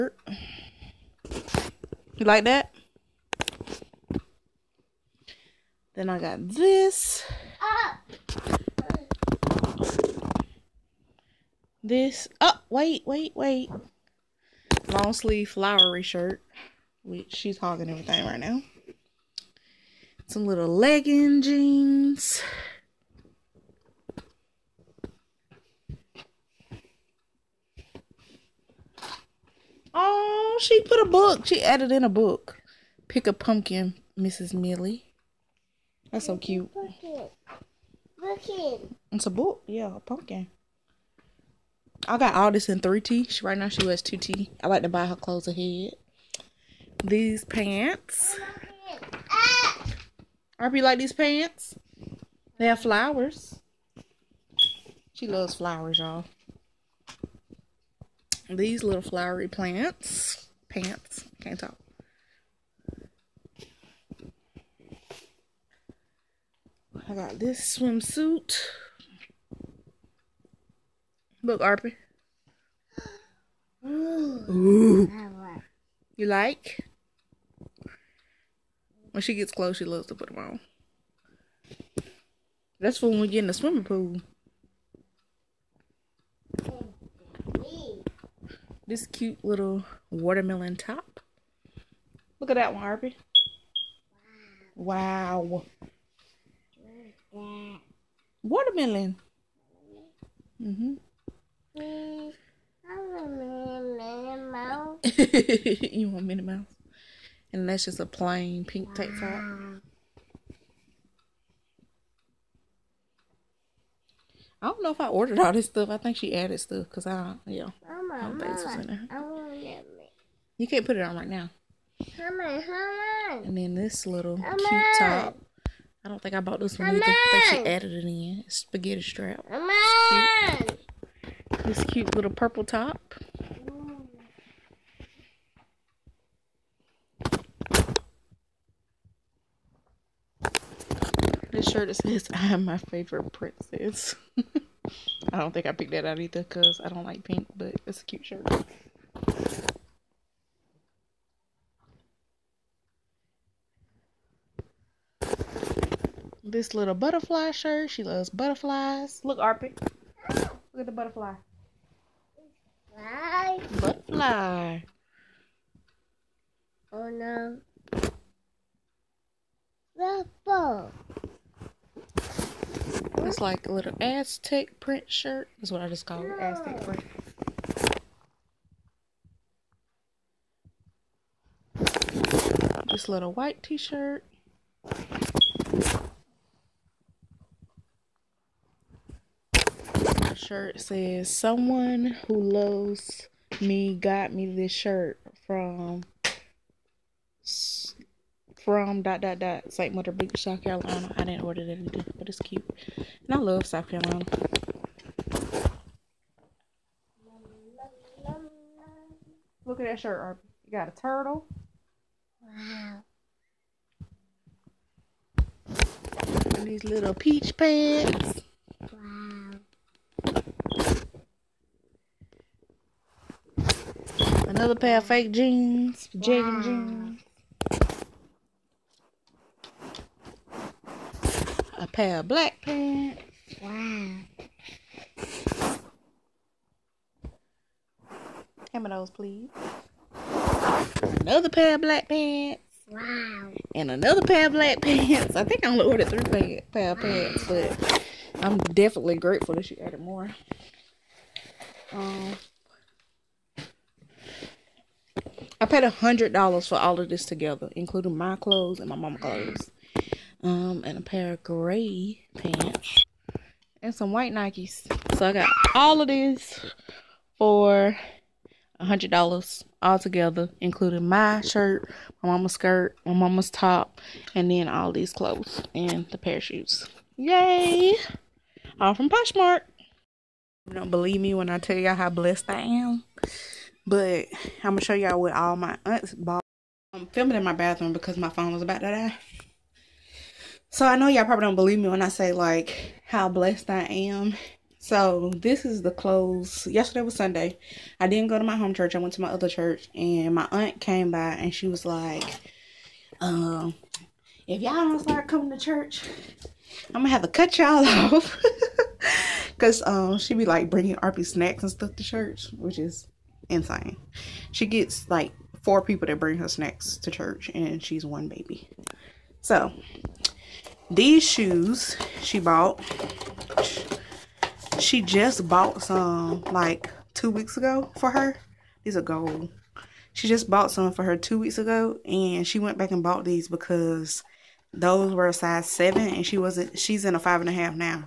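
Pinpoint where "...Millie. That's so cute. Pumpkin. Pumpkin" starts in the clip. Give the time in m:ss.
0:34.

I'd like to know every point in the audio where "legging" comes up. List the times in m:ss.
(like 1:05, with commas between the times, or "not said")
0:20.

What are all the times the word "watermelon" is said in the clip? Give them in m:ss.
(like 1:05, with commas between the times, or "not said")
1:30, 1:38.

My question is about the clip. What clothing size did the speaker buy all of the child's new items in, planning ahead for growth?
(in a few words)
3T.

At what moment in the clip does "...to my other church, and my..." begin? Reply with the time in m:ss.
4:59.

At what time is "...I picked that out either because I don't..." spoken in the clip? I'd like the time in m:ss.
2:25.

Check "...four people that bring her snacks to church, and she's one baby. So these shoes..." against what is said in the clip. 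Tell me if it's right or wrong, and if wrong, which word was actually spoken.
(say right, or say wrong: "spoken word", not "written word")
right.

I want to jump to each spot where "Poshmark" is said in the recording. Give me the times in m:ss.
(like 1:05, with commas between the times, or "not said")
4:39.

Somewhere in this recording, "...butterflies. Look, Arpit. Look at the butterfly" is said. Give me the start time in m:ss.
2:38.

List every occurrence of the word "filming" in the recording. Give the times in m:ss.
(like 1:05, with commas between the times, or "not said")
4:47.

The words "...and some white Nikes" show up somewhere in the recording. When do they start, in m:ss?
4:23.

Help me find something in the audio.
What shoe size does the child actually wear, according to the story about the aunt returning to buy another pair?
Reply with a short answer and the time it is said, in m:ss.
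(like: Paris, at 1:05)
5 and a half, at 5:37.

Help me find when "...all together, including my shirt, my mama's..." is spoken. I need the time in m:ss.
4:29.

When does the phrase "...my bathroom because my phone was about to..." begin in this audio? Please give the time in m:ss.
4:47.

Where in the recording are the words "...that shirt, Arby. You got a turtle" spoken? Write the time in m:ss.
3:29.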